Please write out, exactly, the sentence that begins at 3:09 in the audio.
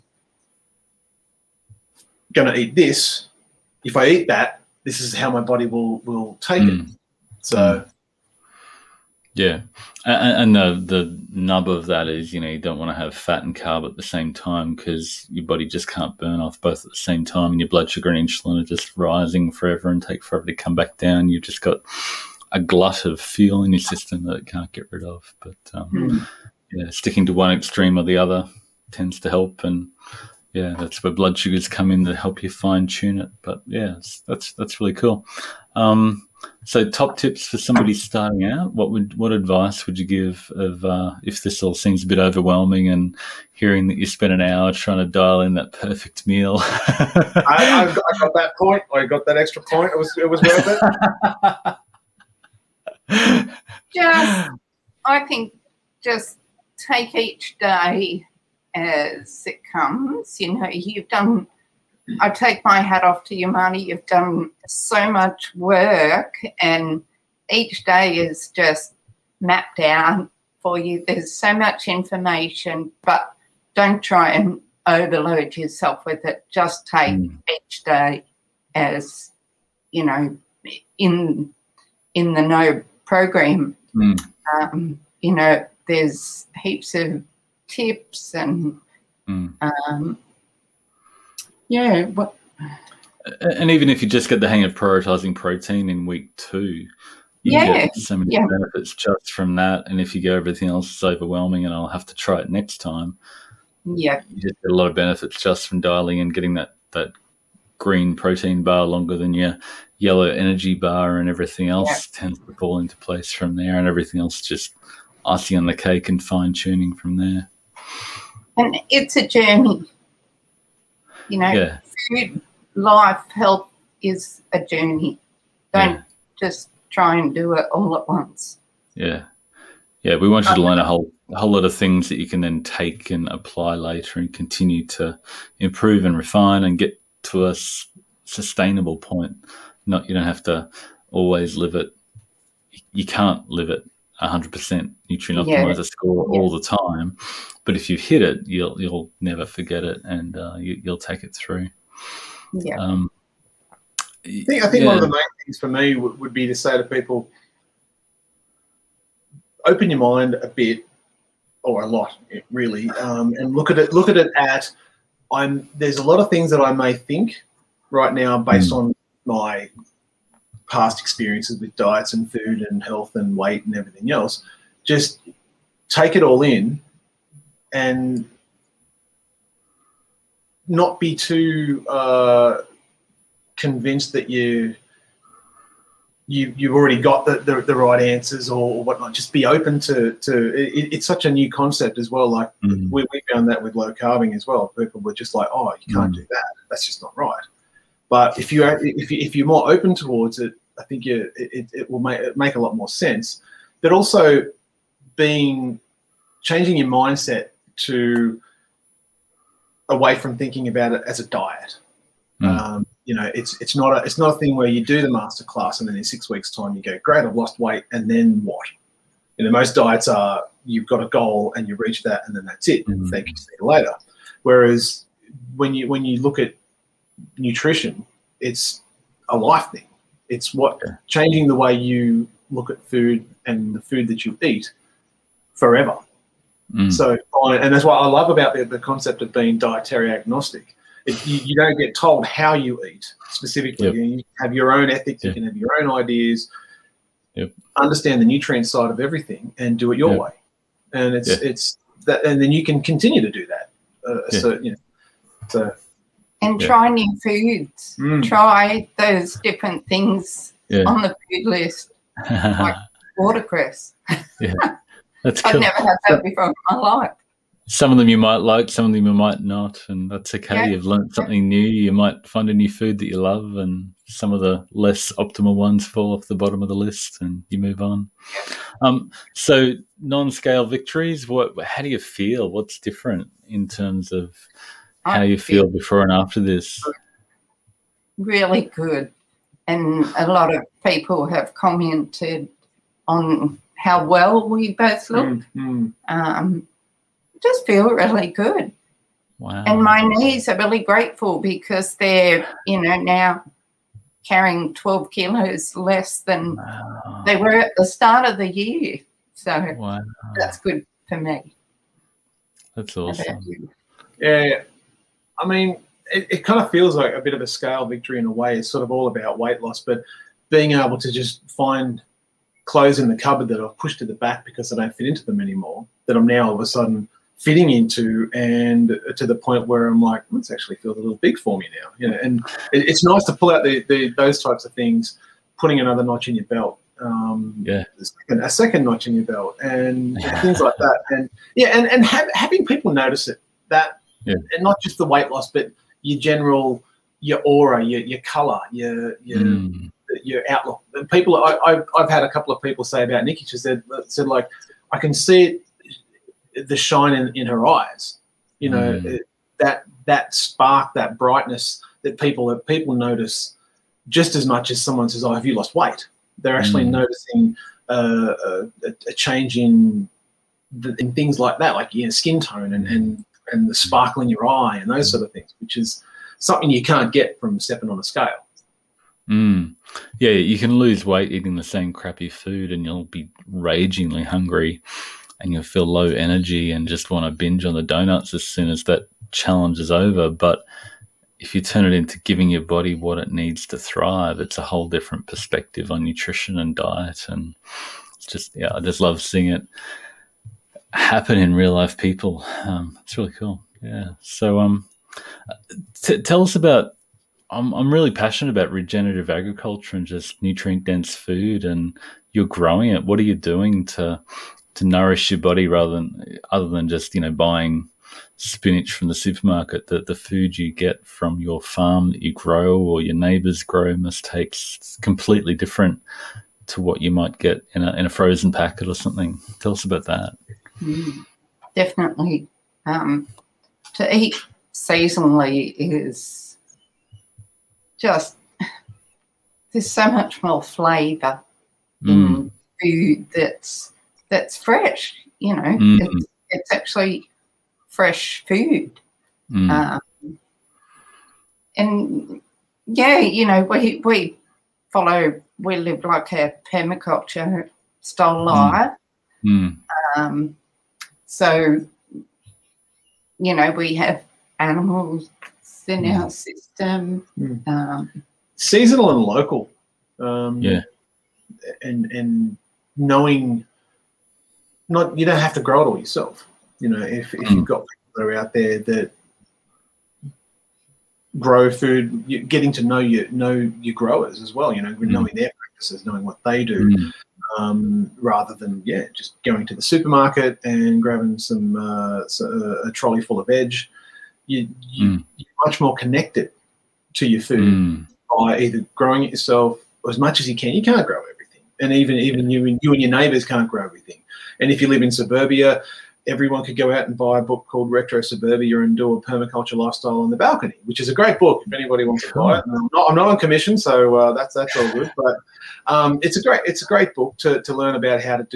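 Just be open to to it, it's such a new concept as well.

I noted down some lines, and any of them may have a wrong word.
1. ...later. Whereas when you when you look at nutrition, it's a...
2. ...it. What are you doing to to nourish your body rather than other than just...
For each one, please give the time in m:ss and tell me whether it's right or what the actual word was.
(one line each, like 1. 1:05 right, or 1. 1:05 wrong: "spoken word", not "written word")
1. 3:43 right
2. 6:52 right.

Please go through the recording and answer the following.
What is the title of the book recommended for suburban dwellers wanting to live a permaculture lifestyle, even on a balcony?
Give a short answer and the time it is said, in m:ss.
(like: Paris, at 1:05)
Retro Suburbia, at 8:27.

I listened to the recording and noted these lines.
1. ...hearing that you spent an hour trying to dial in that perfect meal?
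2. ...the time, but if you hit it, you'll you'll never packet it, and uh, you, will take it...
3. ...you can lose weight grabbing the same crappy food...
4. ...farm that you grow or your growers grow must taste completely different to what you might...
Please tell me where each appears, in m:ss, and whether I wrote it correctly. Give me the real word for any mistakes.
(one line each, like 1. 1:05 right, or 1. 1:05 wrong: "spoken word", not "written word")
1. 0:43 right
2. 2:26 wrong: "forget", not "packet"
3. 6:20 wrong: "eating", not "grabbing"
4. 7:01 wrong: "neighbors", not "growers".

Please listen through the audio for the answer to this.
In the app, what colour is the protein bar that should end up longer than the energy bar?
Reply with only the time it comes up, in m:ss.
1:47.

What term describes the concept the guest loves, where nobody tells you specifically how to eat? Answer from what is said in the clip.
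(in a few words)
dietary agnostic.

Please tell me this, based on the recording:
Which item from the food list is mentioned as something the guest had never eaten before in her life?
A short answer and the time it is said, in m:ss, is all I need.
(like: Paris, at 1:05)
watercress, at 4:23.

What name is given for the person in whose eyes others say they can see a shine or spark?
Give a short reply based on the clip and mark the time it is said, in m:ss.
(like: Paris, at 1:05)
Nicky, at 5:53.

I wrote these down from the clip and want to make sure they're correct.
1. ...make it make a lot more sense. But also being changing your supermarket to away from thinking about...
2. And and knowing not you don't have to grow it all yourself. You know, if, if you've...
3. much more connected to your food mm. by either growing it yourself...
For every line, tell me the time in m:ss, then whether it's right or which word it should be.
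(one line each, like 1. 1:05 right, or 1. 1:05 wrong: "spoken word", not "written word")
1. 3:22 wrong: "mindset", not "supermarket"
2. 7:51 right
3. 8:15 right.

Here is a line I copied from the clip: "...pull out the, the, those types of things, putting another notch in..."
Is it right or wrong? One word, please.
right.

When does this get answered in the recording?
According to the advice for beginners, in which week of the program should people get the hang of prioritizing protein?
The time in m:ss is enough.
1:36.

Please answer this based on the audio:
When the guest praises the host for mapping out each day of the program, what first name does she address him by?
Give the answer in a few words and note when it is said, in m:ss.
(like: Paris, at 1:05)
Marty, at 1:03.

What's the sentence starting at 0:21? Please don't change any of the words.
You've just got a glut of fuel in your system that it can't get rid of.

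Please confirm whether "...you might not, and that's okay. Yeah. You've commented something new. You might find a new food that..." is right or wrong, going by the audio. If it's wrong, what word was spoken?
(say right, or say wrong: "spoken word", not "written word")
wrong: "learned", not "commented".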